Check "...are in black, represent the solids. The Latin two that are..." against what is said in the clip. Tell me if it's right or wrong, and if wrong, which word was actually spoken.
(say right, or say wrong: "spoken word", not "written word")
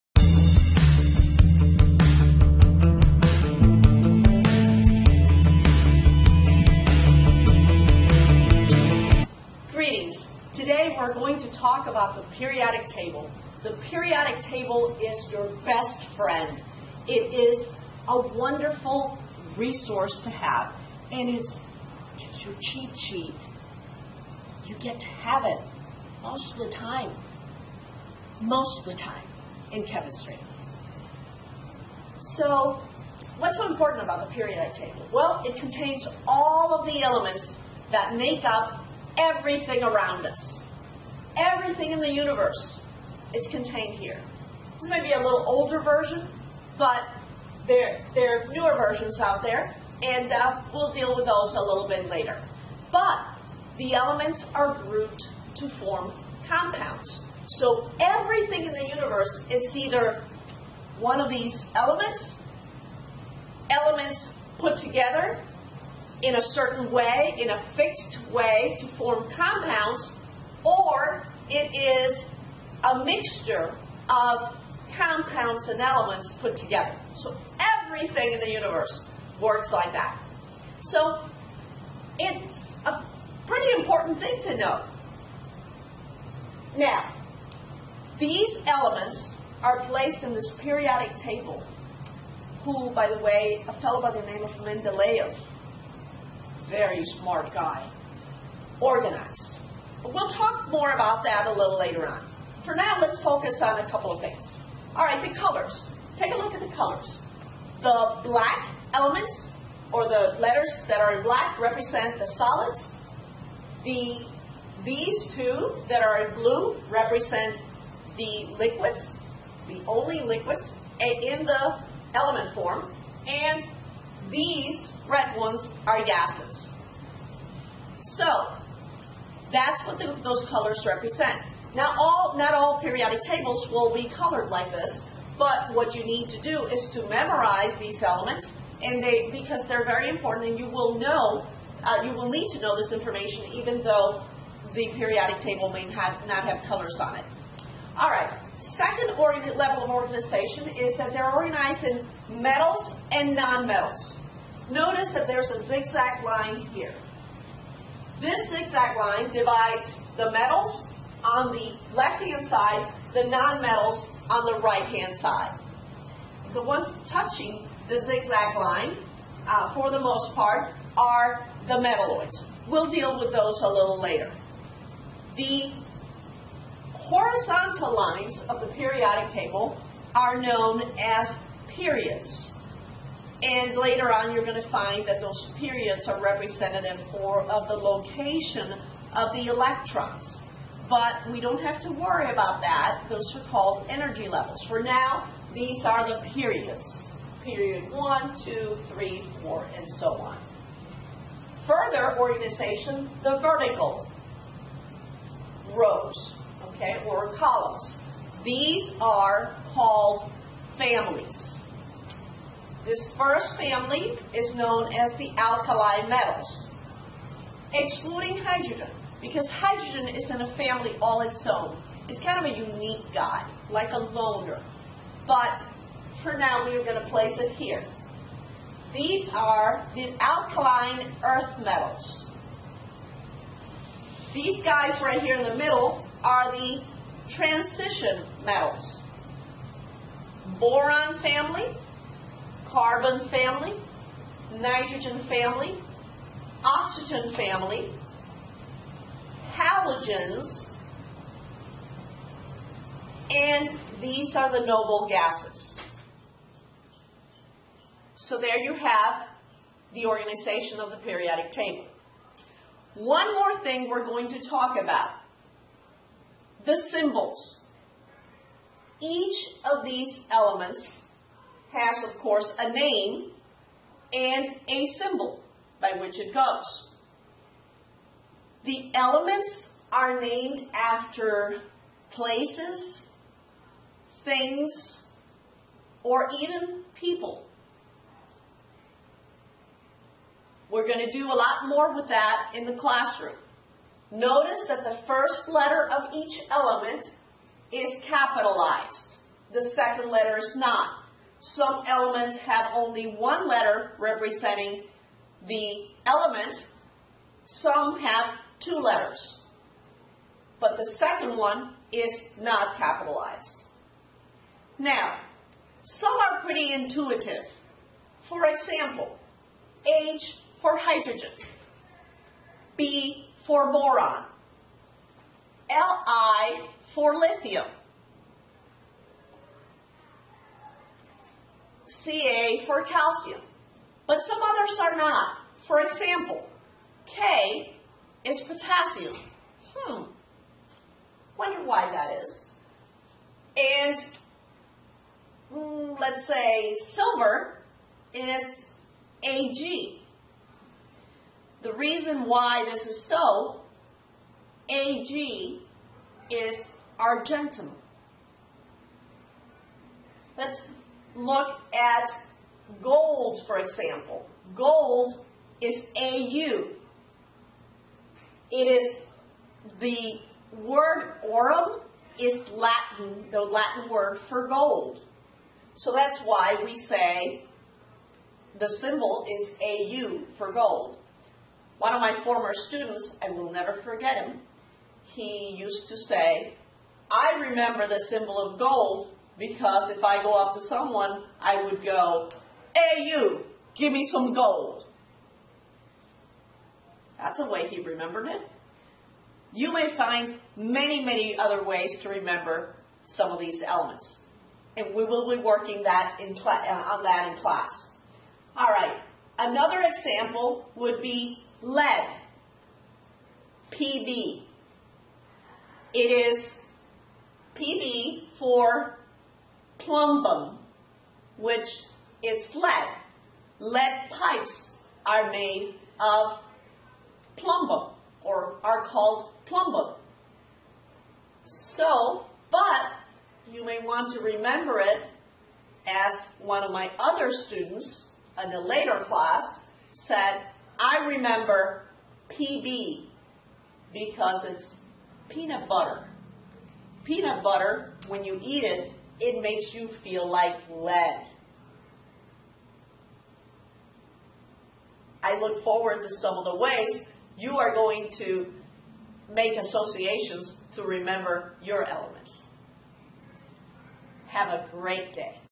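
wrong: "These", not "Latin".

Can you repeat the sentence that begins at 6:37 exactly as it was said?
That's a way he remembered it.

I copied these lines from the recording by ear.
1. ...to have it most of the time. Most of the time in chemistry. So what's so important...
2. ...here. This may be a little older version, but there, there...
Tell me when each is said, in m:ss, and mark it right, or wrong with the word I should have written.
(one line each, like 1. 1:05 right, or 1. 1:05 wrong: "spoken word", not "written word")
1. 0:24 right
2. 0:43 right.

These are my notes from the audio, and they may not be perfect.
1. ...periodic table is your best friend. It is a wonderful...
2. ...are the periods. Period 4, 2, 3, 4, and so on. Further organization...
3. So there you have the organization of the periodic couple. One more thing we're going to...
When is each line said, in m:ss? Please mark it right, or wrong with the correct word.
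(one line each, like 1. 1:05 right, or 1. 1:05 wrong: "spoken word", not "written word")
1. 0:13 right
2. 3:15 wrong: "1", not "4"
3. 4:18 wrong: "table", not "couple".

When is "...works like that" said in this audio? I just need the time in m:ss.
1:19.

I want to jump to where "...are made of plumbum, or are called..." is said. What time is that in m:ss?
7:05.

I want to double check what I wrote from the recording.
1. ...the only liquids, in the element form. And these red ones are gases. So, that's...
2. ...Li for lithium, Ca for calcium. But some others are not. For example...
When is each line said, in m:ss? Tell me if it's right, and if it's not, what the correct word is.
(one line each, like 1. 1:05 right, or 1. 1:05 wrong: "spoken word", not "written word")
1. 1:59 right
2. 5:25 right.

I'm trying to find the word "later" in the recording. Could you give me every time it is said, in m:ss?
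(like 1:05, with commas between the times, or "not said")
0:52, 1:41, 2:53, 3:03, 7:18.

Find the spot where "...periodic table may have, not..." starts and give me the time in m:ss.
2:24.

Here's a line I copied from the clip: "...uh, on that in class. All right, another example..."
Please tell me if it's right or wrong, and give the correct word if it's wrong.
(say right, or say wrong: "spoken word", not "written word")
right.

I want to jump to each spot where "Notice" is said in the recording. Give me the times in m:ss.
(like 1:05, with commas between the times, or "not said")
2:34, 4:54.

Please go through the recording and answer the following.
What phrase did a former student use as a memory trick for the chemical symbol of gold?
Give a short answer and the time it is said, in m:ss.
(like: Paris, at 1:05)
Hey you, give me some gold, at 6:32.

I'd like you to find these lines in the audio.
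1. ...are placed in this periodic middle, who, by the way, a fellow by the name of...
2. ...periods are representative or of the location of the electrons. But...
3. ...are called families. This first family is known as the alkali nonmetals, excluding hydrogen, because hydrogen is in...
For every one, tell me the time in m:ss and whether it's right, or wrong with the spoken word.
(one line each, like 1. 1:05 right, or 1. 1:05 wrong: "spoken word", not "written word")
1. 1:29 wrong: "table", not "middle"
2. 3:05 right
3. 3:29 wrong: "metals", not "nonmetals".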